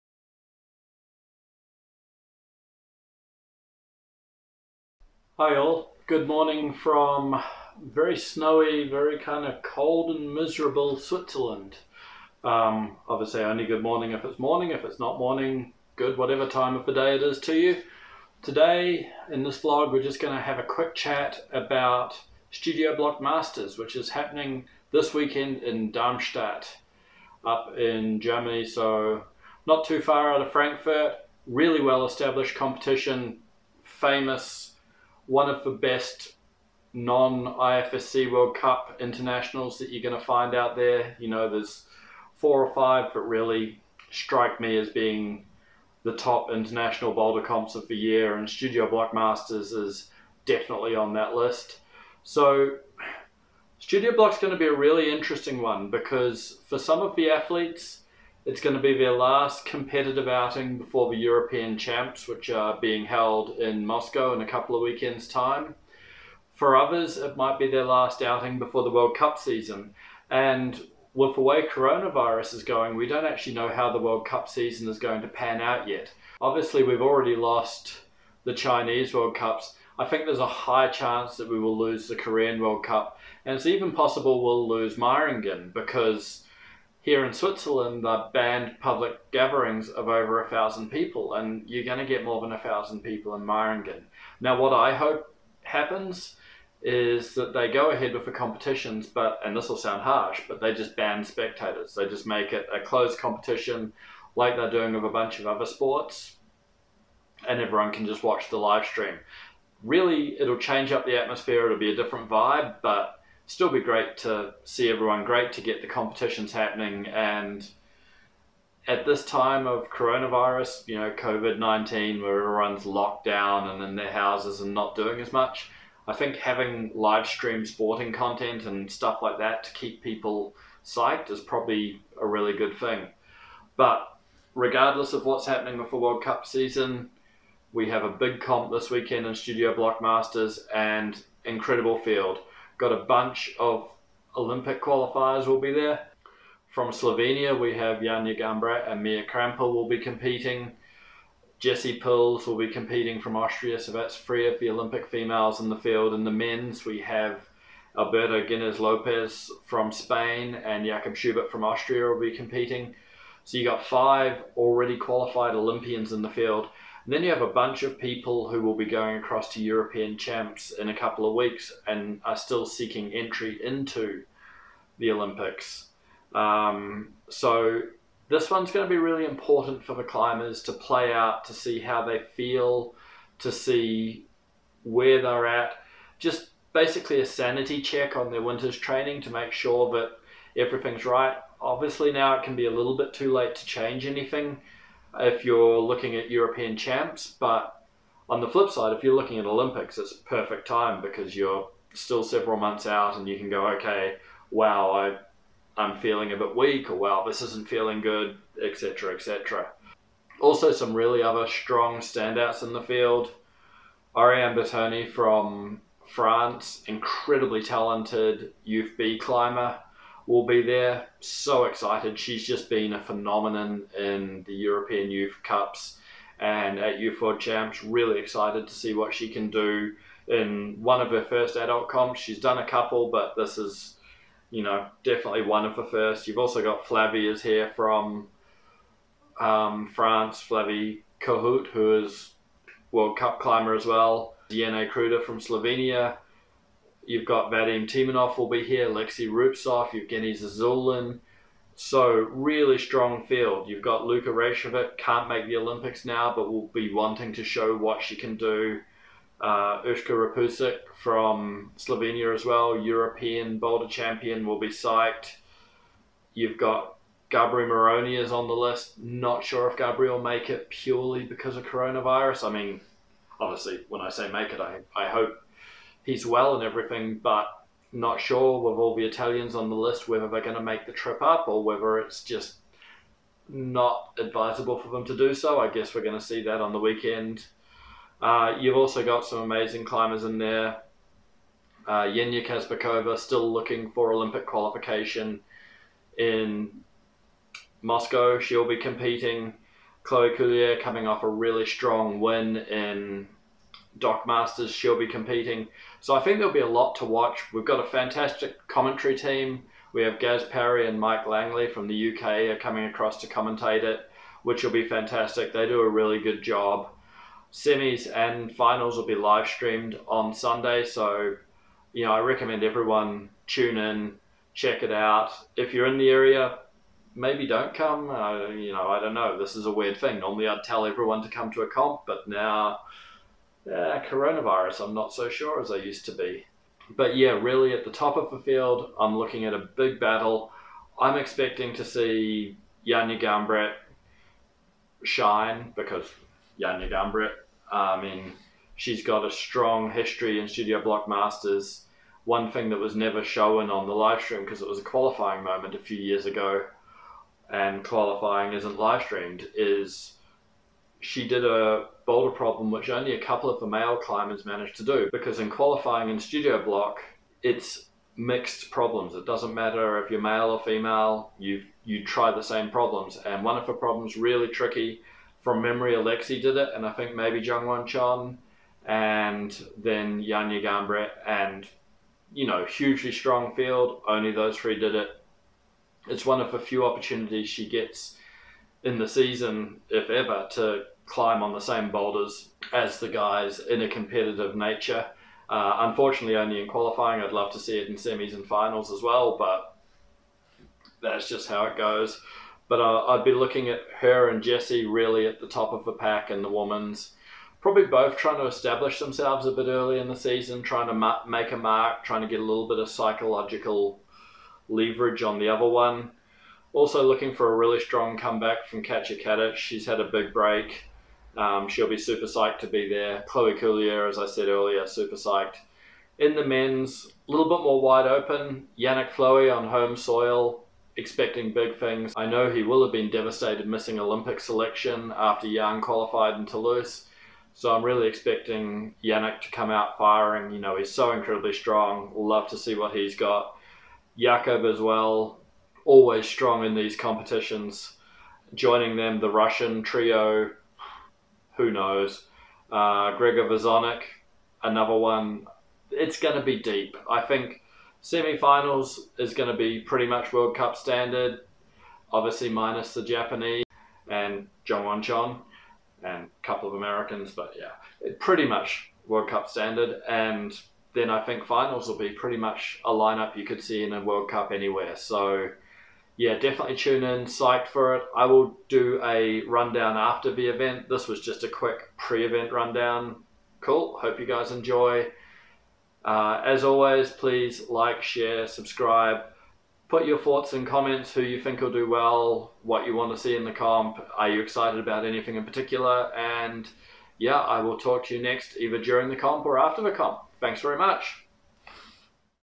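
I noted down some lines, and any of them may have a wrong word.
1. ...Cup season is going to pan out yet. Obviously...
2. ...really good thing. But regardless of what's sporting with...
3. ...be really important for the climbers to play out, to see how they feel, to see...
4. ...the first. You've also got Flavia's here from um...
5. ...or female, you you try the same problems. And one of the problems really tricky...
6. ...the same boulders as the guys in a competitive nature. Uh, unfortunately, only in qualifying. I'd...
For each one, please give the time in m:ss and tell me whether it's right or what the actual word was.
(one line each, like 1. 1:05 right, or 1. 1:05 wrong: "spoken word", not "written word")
1. 1:14 right
2. 2:12 wrong: "happening", not "sporting"
3. 2:58 right
4. 3:55 right
5. 6:10 right
6. 6:31 right.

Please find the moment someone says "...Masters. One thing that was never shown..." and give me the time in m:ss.
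5:51.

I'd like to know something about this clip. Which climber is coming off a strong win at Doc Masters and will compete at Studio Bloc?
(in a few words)
Chloe Caulier.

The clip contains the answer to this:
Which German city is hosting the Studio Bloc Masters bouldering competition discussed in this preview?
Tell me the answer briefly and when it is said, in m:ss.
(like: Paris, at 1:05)
Darmstadt, at 0:25.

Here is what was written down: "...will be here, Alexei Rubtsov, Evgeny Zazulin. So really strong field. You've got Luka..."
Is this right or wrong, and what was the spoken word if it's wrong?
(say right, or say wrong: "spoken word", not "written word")
right.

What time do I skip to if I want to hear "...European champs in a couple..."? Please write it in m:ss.
2:49.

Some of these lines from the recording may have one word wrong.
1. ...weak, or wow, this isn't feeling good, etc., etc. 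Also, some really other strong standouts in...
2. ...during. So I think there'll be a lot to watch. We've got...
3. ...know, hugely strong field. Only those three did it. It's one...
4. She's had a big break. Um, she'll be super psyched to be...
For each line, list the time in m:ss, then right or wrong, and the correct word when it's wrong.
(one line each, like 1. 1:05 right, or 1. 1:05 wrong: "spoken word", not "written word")
1. 3:26 right
2. 5:05 wrong: "competing", not "during"
3. 6:22 right
4. 6:59 right.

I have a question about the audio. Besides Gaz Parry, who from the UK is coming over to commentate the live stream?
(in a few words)
Mike Langley.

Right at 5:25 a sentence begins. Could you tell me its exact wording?
If you're in the area, maybe don't come.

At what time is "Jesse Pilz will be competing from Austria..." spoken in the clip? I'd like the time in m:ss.
2:31.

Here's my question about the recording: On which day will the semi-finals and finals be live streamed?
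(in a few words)
Sunday.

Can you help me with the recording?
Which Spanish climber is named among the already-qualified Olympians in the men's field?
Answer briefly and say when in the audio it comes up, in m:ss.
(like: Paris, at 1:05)
Alberto Ginés Lopez, at 2:37.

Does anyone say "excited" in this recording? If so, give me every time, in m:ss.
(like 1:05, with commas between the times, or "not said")
3:41, 3:48, 8:14.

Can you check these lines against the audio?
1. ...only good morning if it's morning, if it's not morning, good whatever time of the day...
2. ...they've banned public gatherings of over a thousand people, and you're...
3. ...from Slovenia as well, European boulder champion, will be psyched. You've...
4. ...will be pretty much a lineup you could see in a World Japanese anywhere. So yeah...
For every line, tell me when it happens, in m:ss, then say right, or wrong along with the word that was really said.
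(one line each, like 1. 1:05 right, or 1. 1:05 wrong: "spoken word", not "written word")
1. 0:13 right
2. 1:28 right
3. 4:21 right
4. 7:51 wrong: "Cup", not "Japanese".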